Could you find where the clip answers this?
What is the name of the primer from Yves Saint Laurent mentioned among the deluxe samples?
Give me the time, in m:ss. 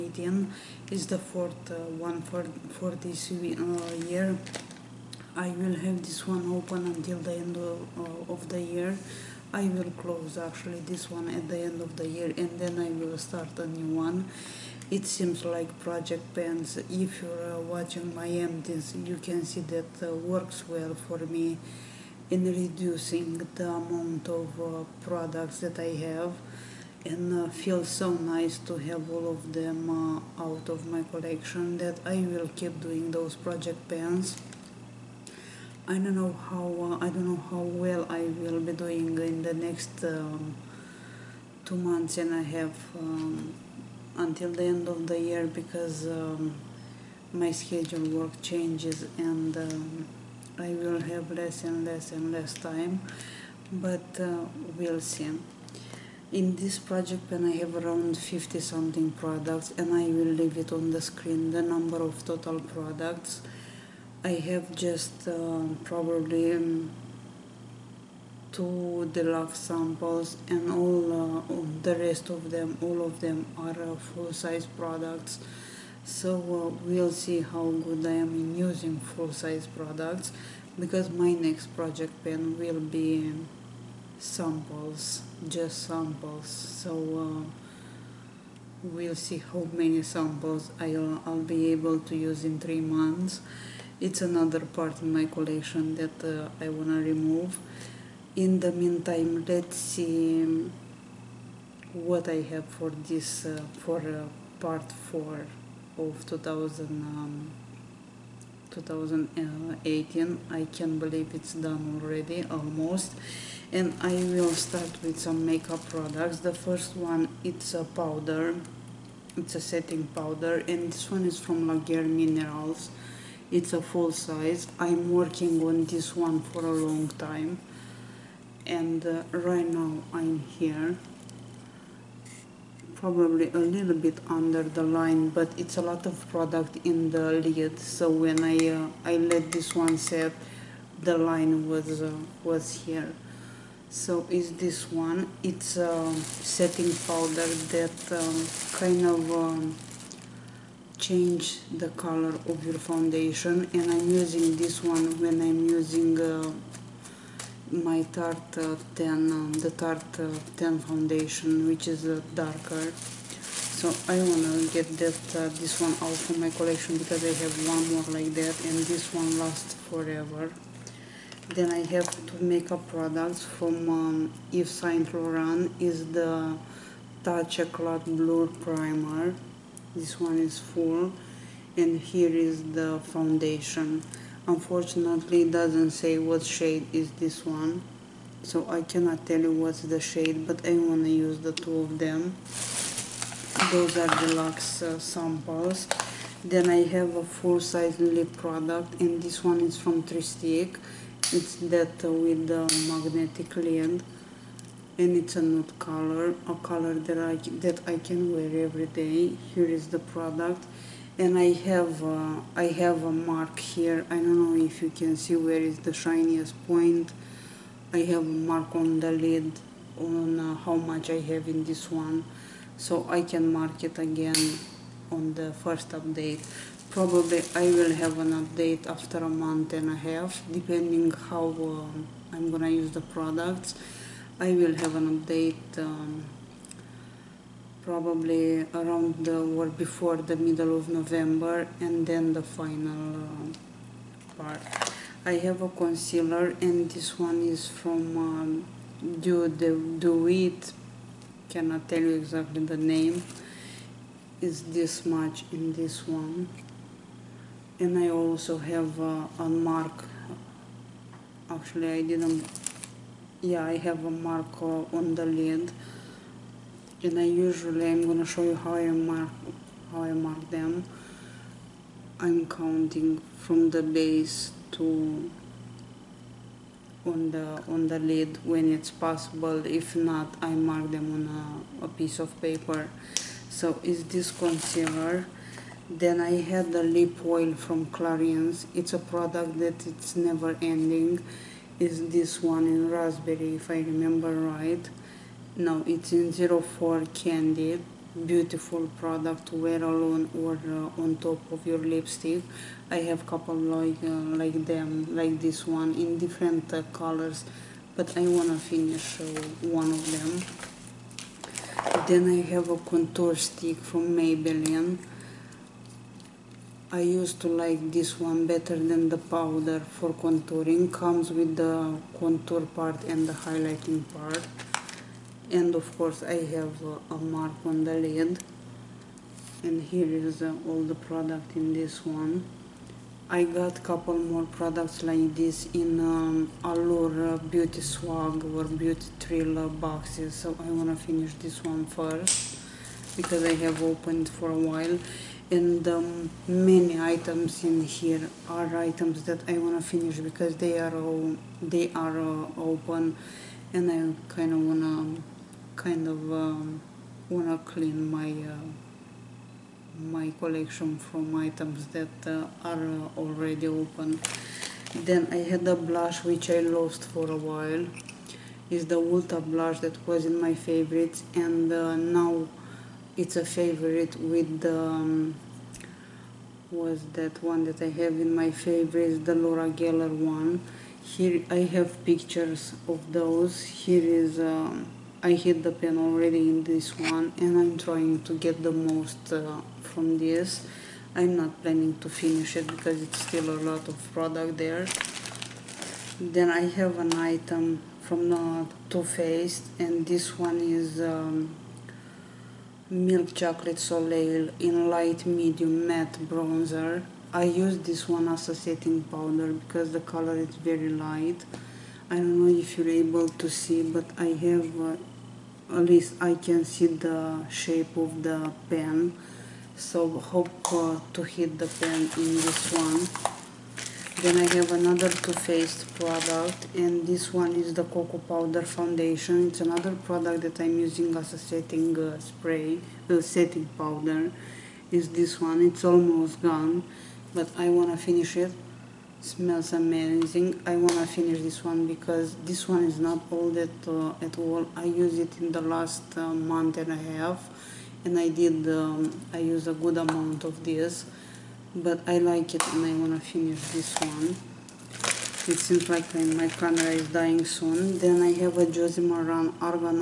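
2:57.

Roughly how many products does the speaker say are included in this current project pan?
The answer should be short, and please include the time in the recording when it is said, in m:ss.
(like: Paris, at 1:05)
50 something, at 0:58.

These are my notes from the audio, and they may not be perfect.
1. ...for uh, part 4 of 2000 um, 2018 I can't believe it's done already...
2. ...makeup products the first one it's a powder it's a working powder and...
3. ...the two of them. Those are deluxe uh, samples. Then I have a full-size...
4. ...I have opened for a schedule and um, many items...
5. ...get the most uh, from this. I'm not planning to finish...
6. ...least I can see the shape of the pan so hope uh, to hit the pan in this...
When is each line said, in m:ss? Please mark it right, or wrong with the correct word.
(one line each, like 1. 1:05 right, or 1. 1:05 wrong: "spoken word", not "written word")
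1. 1:43 right
2. 1:55 wrong: "setting", not "working"
3. 3:11 right
4. 5:43 wrong: "while", not "schedule"
5. 6:28 right
6. 6:55 right.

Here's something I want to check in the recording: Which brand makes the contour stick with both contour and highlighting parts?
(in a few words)
Maybelline.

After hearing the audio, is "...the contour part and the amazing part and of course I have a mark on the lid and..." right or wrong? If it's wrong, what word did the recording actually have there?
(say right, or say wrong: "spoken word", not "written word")
wrong: "highlighting", not "amazing".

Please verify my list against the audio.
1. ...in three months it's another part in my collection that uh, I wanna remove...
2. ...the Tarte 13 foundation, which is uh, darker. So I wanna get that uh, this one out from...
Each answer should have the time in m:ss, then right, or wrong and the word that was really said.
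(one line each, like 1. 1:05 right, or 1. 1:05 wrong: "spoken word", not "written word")
1. 1:32 right
2. 2:39 wrong: "10", not "13".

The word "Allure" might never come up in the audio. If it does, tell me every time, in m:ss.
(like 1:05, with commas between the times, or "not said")
5:36.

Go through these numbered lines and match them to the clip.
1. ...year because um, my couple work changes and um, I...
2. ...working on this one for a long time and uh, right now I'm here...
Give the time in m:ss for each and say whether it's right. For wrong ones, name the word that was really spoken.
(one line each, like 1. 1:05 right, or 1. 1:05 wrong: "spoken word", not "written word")
1. 0:45 wrong: "schedule", not "couple"
2. 2:05 right.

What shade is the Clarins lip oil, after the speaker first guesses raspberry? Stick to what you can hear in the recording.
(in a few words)
04 Candy.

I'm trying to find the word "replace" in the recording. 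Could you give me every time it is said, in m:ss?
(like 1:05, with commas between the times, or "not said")
not said.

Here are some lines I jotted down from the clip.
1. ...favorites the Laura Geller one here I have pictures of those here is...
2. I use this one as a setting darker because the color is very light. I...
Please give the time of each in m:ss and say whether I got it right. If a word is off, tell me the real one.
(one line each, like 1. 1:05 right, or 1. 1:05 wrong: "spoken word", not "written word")
1. 6:18 right
2. 6:47 wrong: "powder", not "darker".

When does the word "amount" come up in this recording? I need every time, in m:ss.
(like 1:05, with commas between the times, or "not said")
0:23, 7:29.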